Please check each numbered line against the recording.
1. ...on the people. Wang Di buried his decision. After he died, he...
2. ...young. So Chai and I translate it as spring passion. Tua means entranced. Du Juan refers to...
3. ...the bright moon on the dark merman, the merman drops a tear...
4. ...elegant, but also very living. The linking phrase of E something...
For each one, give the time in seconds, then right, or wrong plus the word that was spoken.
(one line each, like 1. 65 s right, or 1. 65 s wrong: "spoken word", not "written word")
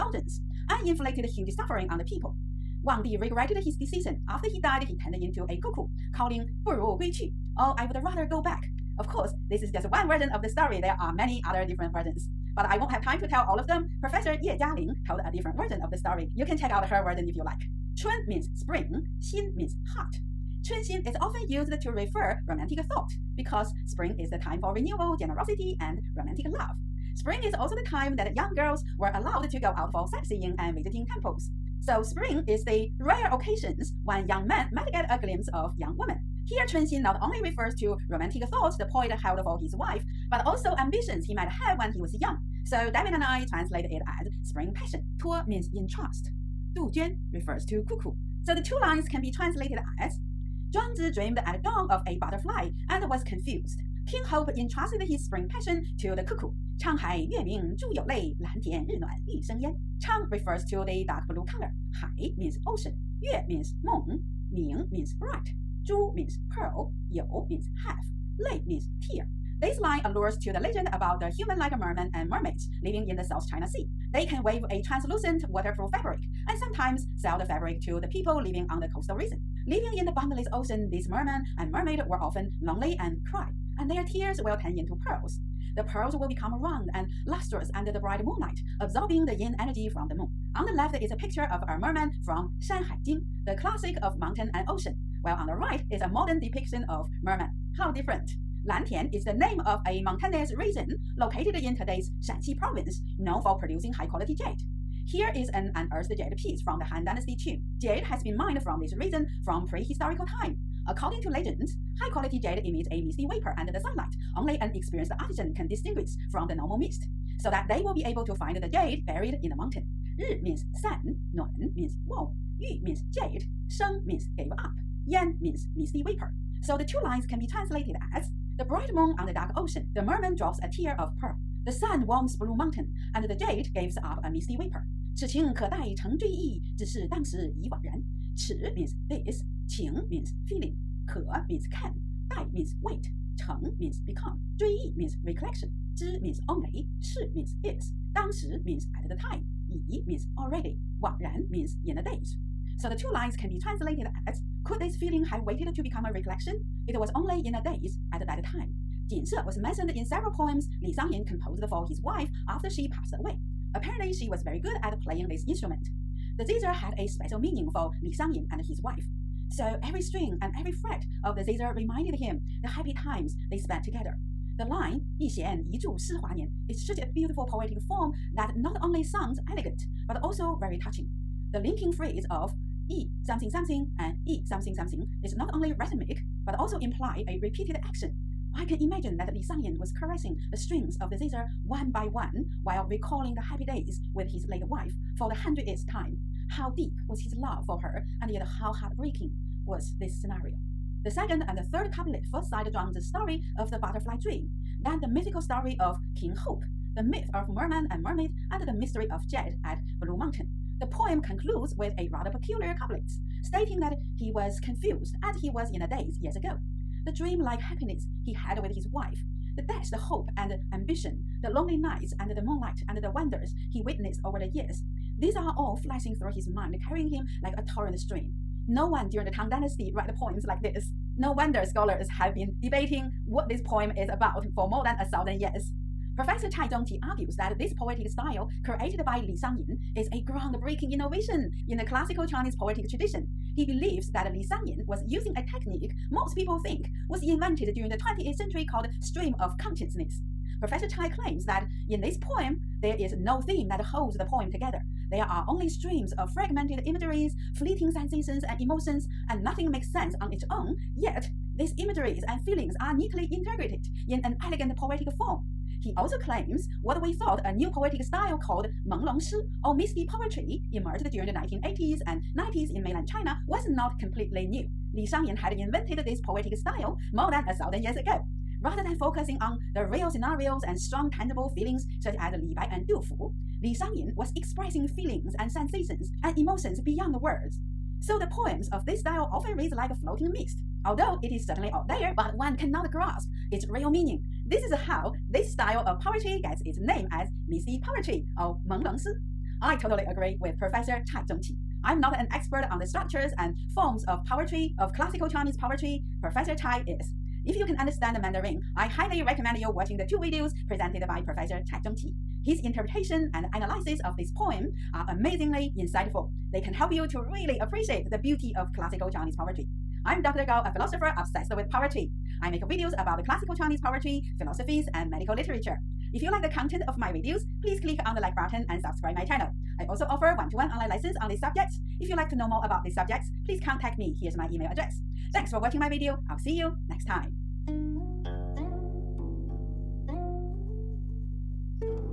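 1. 1 s wrong: "regretted", not "buried"
2. 42 s wrong: "David", not "Chai"
3. 128 s wrong: "ocean", not "merman"
4. 179 s wrong: "touching", not "living".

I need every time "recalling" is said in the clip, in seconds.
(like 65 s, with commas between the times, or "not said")
192 s.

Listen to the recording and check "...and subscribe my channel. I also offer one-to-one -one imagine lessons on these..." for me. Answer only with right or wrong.
wrong.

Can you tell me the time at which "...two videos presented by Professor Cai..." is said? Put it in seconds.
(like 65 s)
310 s.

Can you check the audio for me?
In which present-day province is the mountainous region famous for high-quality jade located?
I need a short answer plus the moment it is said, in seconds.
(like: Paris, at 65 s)
Shaanxi, at 102 s.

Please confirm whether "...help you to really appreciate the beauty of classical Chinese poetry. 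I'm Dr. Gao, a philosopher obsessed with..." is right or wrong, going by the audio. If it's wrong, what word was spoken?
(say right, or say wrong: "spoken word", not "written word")
right.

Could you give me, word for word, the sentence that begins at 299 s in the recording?
I totally agree with Professor Chai Zhengqi.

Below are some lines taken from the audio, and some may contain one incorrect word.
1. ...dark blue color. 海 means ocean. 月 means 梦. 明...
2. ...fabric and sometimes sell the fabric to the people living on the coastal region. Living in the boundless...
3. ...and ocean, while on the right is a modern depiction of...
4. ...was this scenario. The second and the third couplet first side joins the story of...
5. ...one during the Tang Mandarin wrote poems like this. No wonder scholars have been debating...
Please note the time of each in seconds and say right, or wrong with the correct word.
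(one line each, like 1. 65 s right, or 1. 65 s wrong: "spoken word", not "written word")
1. 61 s right
2. 75 s right
3. 94 s right
4. 199 s right
5. 228 s wrong: "Dynasty", not "Mandarin".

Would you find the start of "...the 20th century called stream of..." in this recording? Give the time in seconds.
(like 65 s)
247 s.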